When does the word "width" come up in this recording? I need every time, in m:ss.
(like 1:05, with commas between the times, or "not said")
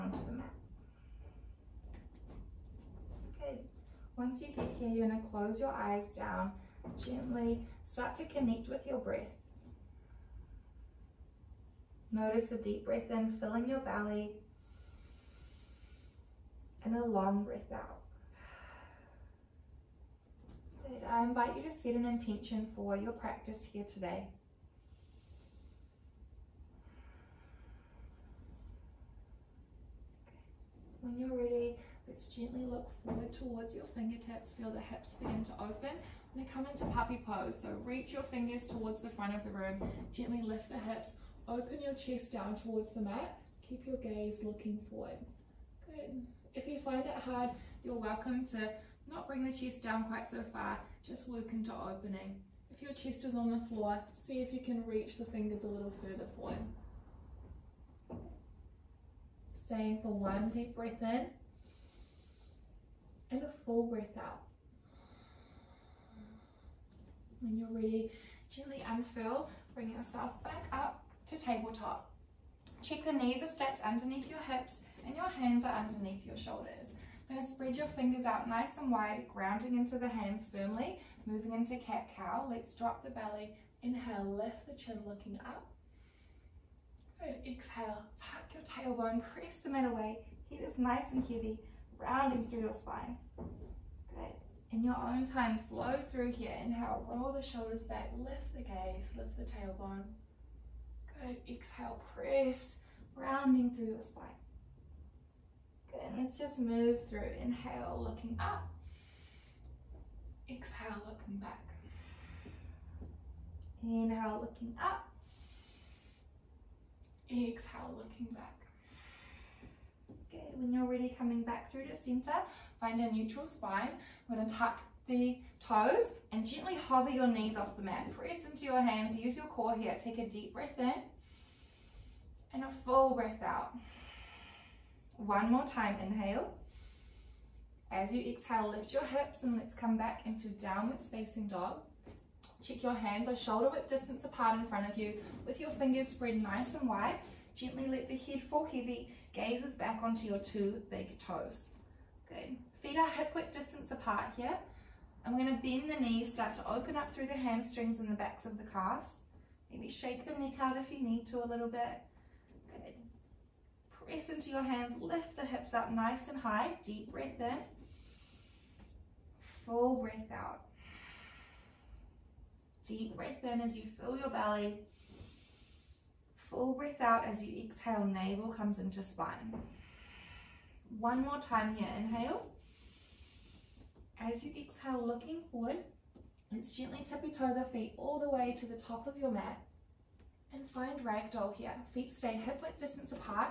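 2:23, 2:33, 3:12.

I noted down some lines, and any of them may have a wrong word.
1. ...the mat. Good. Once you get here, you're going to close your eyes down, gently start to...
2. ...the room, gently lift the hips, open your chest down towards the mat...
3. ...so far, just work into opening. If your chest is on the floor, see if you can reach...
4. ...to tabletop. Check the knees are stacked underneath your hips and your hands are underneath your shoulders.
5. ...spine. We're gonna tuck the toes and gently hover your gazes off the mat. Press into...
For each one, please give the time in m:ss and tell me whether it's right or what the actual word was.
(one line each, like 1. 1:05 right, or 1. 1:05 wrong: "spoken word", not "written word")
1. 0:00 right
2. 0:39 right
3. 0:50 right
4. 1:11 right
5. 2:03 wrong: "knees", not "gazes".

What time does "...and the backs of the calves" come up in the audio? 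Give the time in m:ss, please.
2:37.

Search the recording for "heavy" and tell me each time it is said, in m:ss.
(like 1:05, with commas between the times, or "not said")
1:31, 2:28.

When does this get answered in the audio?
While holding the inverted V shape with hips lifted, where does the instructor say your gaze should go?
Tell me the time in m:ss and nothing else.
2:30.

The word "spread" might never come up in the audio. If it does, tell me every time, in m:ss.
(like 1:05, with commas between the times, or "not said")
1:17, 2:26.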